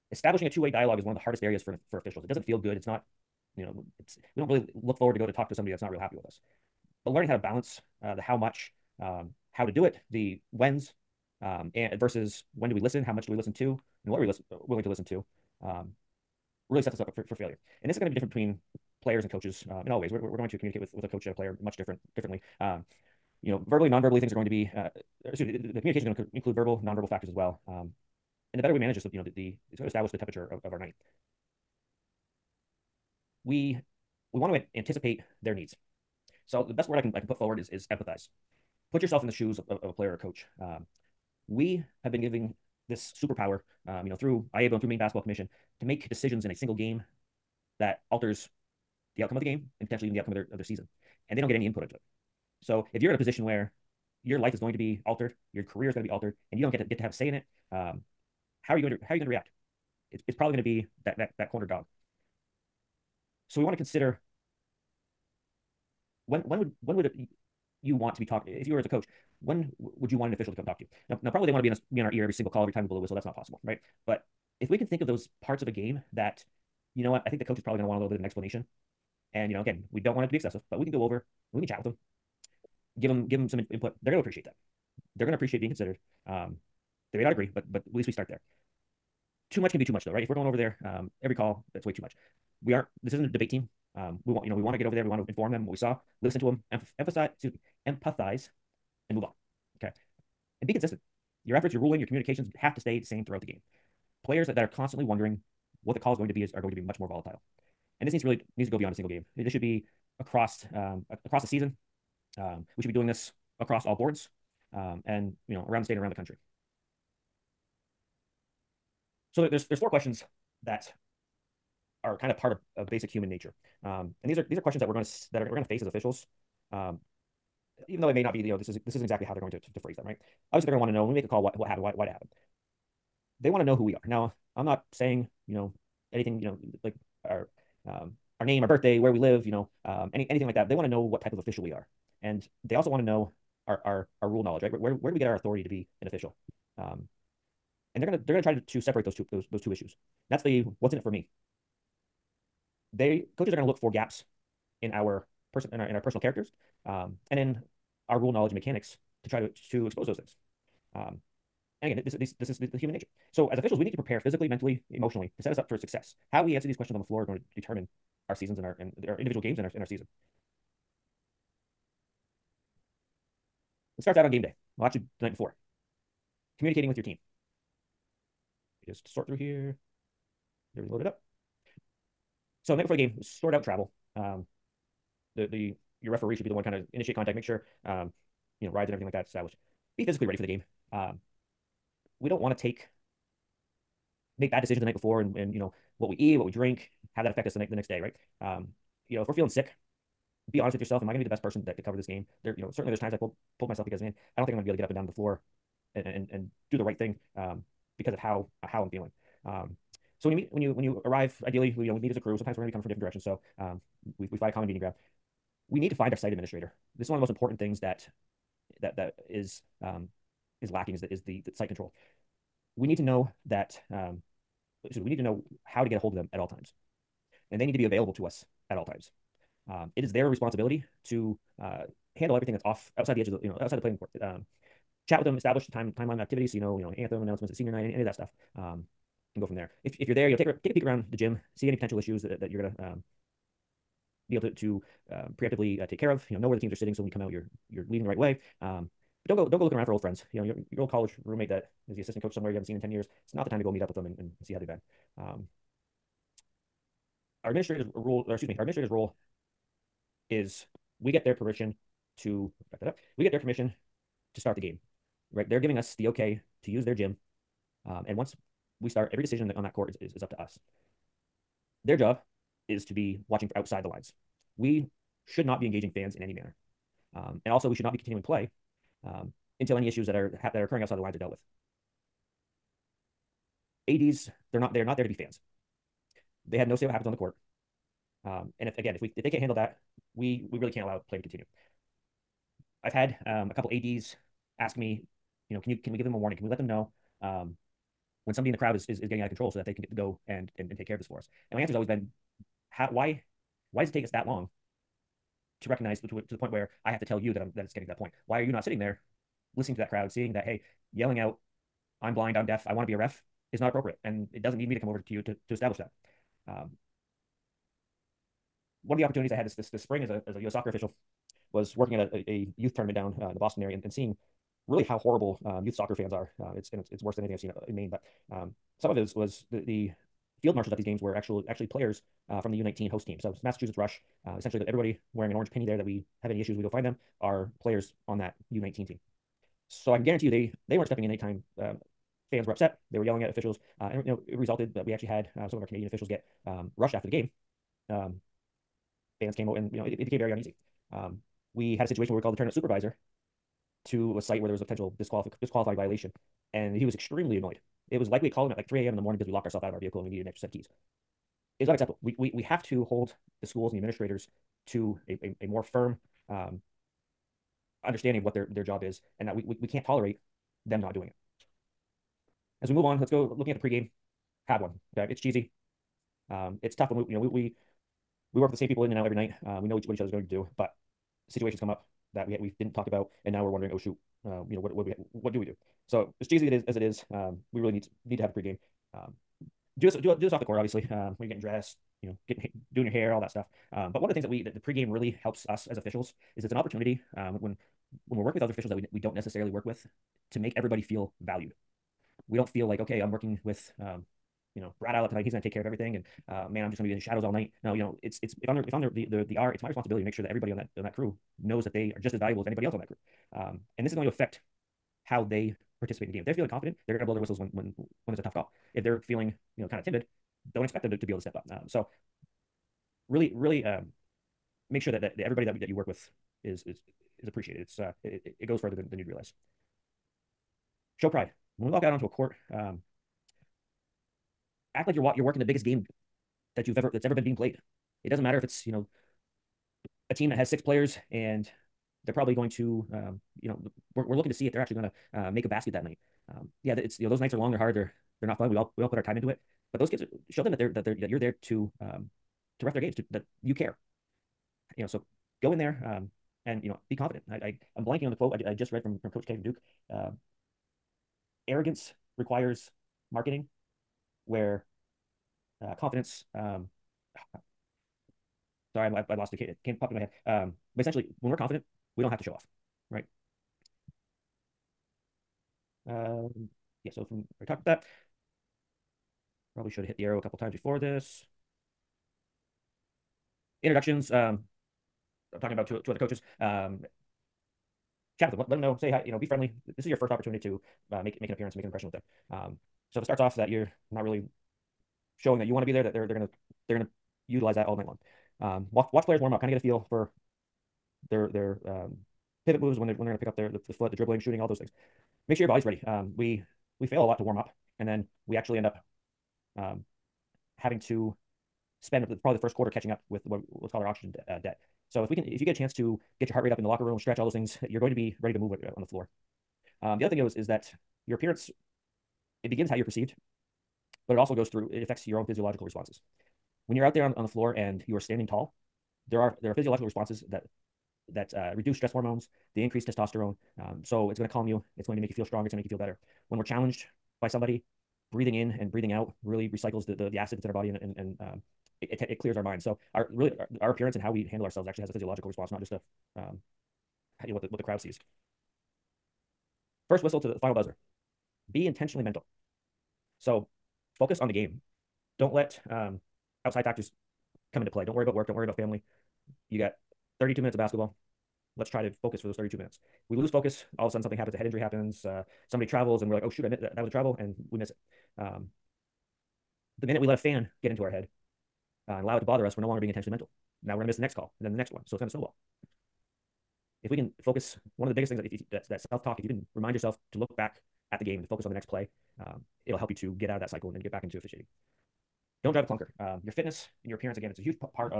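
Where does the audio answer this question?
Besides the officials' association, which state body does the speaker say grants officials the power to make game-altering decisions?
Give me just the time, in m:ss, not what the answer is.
0:44.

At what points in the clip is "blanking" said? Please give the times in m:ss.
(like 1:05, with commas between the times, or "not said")
7:37.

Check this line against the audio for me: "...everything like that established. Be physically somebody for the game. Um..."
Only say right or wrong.
wrong.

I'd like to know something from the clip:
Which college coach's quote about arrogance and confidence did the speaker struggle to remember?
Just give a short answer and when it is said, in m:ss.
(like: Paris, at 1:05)
Coach K, at 7:39.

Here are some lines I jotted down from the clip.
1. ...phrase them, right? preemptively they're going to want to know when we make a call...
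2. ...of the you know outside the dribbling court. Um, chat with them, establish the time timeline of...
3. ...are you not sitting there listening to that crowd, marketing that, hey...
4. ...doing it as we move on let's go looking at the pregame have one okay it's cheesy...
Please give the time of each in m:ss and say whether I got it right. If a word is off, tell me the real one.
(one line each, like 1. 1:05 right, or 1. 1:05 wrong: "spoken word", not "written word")
1. 2:09 wrong: "obviously", not "preemptively"
2. 3:53 wrong: "playing", not "dribbling"
3. 5:08 wrong: "seeing", not "marketing"
4. 6:10 right.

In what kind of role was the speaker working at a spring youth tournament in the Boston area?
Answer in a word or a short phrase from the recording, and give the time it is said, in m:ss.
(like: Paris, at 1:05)
U.S. soccer official, at 5:20.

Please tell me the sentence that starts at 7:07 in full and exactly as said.
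It's uh, it, it it goes further than than you'd realize show pride.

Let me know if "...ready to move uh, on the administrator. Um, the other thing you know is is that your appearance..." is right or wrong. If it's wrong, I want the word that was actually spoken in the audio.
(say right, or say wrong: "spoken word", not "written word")
wrong: "floor", not "administrator".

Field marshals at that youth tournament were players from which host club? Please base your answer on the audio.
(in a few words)
Massachusetts Rush.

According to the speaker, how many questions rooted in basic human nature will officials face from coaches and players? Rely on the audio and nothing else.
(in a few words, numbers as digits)
4.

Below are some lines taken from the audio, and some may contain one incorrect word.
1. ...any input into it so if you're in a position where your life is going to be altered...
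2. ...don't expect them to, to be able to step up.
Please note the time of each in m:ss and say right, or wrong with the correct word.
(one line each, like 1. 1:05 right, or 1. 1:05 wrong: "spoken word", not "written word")
1. 0:51 right
2. 7:00 right.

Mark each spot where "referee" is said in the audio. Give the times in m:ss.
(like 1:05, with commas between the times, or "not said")
3:06.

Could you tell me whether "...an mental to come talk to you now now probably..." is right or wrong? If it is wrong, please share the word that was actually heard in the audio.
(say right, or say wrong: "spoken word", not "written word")
wrong: "official", not "mental".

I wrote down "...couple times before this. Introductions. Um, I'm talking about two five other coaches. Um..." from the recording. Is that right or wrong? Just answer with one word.
wrong.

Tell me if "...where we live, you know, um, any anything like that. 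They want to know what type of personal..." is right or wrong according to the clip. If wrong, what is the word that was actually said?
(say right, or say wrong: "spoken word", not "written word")
wrong: "official", not "personal".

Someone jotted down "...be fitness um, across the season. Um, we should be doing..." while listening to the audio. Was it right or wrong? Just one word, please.
wrong.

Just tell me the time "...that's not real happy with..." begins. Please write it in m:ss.
0:05.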